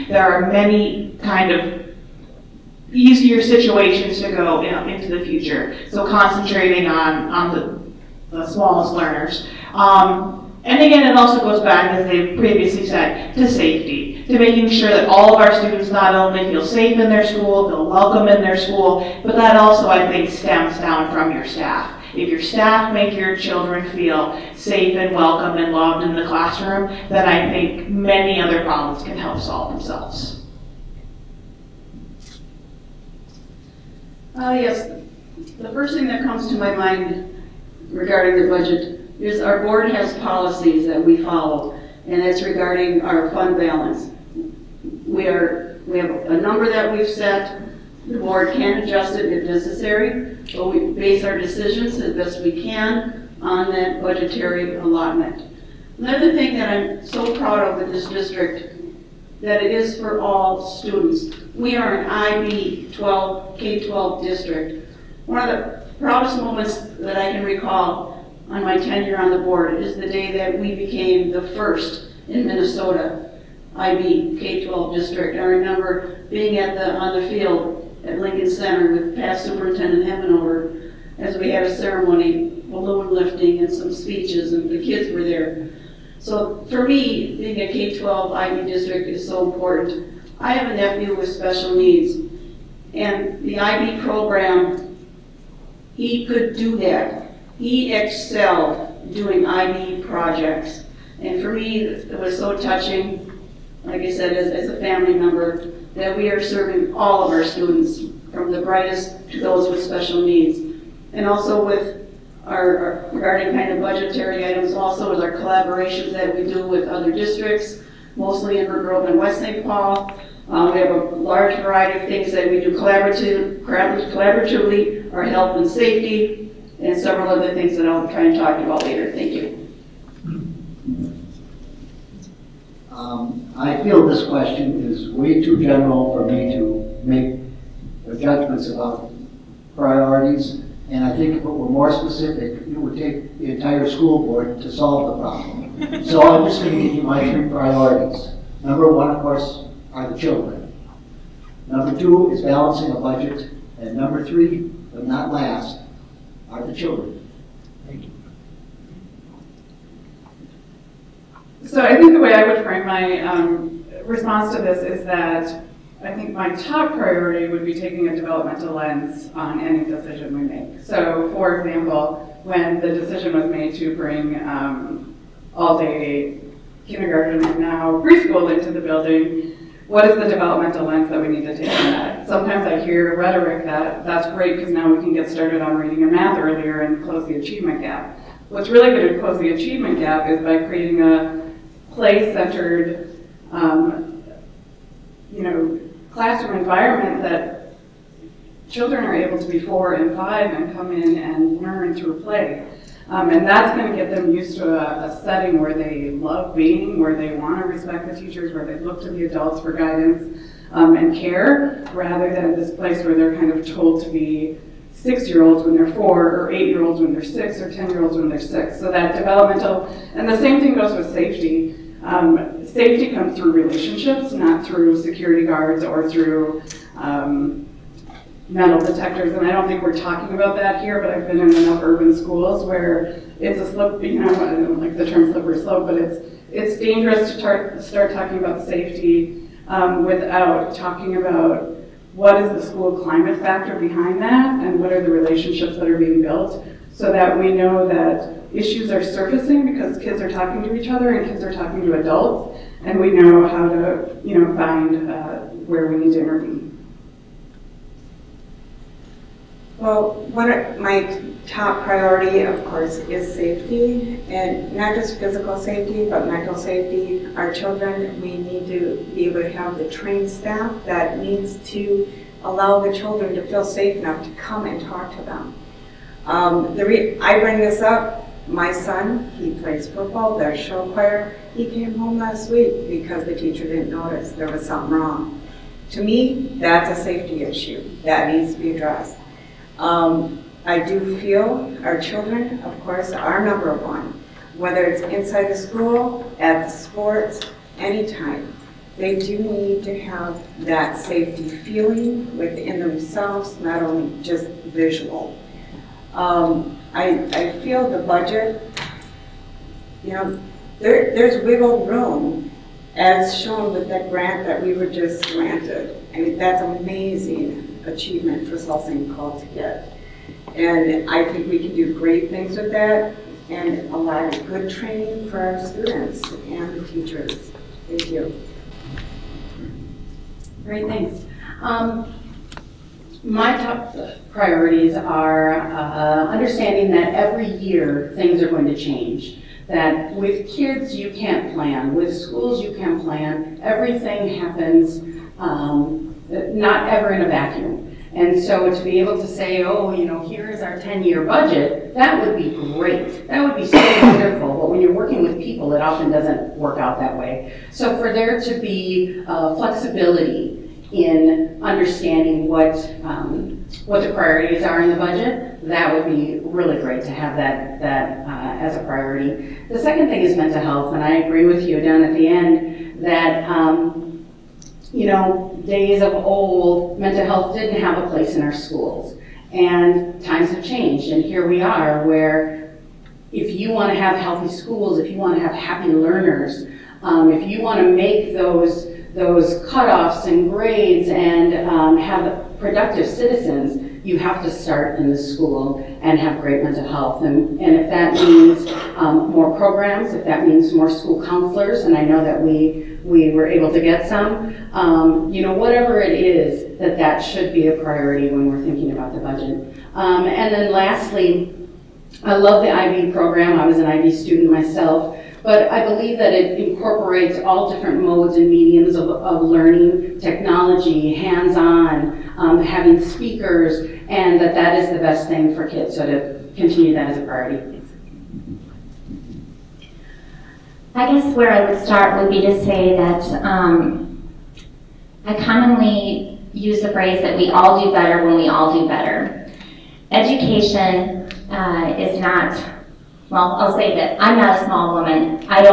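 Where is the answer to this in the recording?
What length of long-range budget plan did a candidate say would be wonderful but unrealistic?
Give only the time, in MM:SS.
05:50.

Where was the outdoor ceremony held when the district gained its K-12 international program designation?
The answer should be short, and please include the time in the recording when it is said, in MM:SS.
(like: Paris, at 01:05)
Lincoln Center, at 01:18.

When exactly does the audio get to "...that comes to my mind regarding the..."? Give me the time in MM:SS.
00:36.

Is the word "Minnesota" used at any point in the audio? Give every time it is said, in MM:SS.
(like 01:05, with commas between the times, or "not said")
01:12.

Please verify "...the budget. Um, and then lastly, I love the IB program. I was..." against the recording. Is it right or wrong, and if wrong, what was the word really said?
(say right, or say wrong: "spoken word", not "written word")
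right.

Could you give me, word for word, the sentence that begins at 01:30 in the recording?
I have a nephew with special needs, and the IB program, he could do that.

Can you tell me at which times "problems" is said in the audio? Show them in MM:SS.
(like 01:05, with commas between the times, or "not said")
00:28, 02:25.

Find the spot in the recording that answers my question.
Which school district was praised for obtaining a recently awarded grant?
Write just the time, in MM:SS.
05:18.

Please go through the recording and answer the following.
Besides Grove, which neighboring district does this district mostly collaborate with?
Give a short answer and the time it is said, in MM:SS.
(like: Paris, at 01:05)
West St. Paul, at 01:59.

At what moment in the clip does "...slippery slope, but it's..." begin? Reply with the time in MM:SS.
03:55.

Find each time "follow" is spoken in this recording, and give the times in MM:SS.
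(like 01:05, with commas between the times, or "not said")
00:41.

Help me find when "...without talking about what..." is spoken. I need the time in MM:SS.
04:00.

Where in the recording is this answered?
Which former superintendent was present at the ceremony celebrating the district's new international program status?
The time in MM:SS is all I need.
01:20.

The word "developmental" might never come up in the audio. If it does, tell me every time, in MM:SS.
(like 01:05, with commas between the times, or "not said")
02:48, 03:00, 03:39.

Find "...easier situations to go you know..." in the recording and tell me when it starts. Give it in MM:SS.
00:02.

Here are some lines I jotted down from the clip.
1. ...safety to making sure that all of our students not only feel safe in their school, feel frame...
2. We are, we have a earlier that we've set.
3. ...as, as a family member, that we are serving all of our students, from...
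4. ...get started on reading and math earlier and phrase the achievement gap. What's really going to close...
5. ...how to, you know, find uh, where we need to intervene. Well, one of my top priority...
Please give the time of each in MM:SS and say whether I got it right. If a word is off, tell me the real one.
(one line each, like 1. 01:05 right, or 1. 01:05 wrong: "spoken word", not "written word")
1. 00:13 wrong: "welcome", not "frame"
2. 00:45 wrong: "number", not "earlier"
3. 01:44 right
4. 03:05 wrong: "close", not "phrase"
5. 04:13 right.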